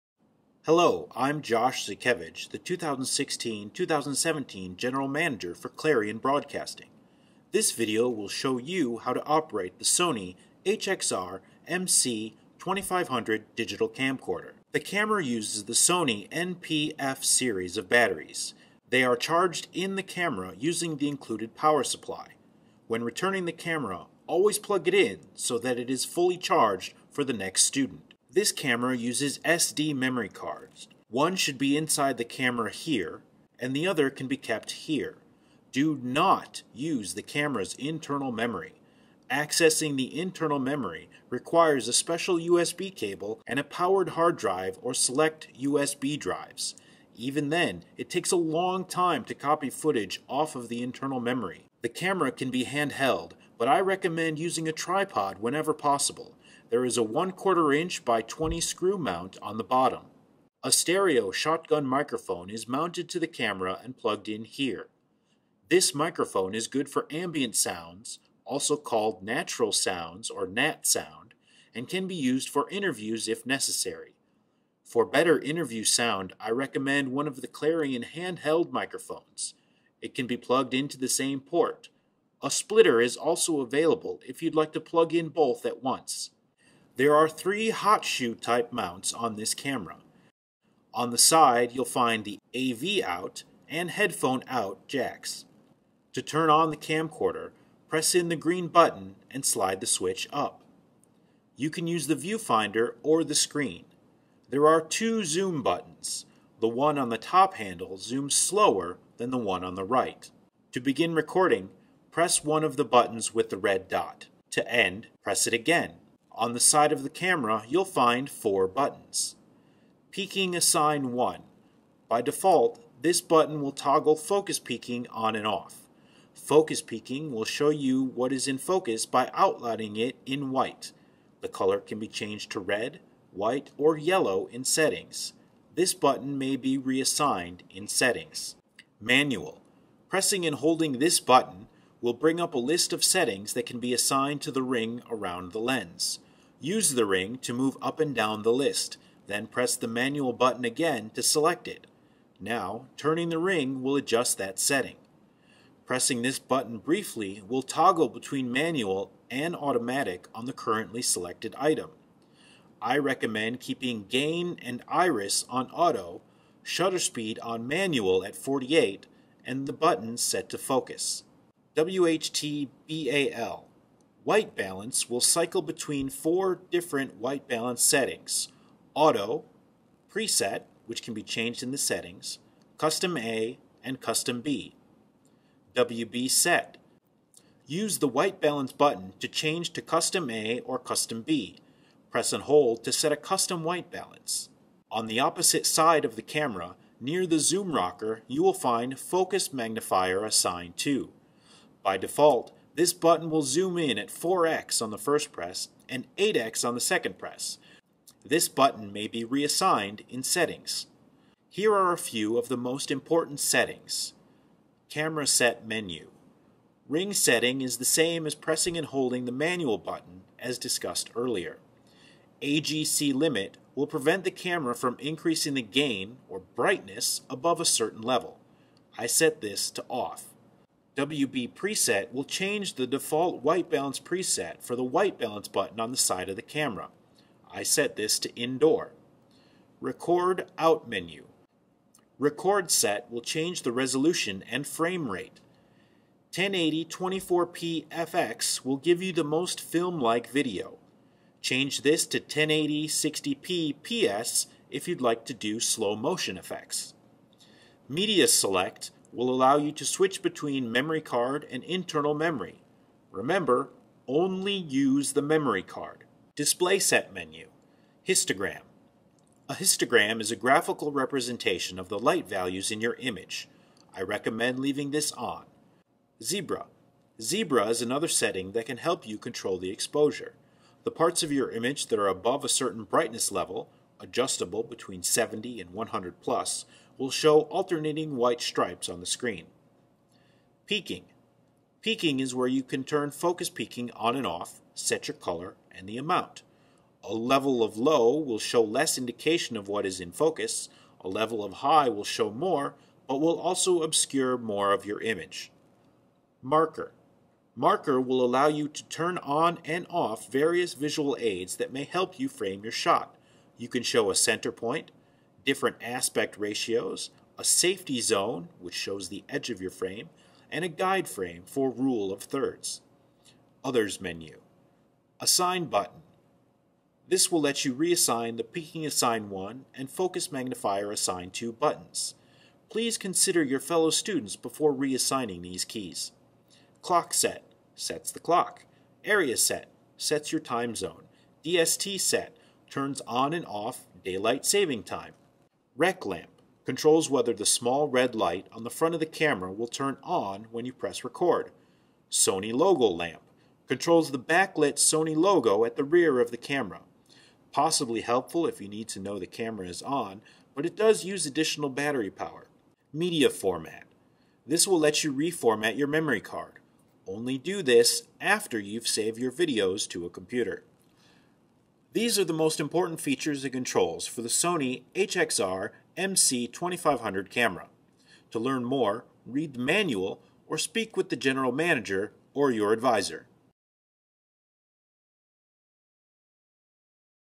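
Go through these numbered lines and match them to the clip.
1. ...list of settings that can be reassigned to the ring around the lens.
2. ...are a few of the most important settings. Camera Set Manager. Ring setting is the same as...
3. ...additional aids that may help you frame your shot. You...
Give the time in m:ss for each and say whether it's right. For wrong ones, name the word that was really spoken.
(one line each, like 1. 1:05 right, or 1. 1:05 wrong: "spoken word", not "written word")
1. 2:22 wrong: "assigned", not "reassigned"
2. 3:31 wrong: "Menu", not "Manager"
3. 5:10 wrong: "visual", not "additional".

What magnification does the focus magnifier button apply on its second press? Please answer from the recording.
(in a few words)
8x.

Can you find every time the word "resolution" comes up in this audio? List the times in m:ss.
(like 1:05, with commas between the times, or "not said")
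4:03.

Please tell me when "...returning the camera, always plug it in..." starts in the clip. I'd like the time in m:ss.
0:23.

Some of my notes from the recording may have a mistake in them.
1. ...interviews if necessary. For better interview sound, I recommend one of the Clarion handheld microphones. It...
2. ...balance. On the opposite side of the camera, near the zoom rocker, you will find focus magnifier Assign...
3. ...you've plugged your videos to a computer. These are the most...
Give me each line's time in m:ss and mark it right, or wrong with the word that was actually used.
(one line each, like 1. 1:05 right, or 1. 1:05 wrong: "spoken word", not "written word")
1. 1:12 right
2. 3:13 right
3. 6:08 wrong: "saved", not "plugged".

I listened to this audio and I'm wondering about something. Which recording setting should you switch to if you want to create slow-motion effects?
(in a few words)
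1080 60p PS.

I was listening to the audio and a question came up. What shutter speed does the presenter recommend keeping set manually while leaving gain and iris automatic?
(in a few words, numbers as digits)
48.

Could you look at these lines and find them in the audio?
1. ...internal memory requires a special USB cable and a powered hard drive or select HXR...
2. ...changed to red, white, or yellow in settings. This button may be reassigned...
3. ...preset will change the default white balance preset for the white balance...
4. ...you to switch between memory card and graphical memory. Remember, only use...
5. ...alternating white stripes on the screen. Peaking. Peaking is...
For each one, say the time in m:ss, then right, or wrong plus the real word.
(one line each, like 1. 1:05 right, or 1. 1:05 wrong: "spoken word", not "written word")
1. 0:40 wrong: "USB", not "HXR"
2. 2:12 right
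3. 3:51 right
4. 4:19 wrong: "internal", not "graphical"
5. 4:47 right.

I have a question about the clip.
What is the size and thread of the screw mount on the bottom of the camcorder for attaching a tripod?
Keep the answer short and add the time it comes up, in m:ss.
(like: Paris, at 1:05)
1/4 inch by 20, at 0:57.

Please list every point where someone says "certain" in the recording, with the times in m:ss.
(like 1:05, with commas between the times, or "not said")
3:47, 4:42.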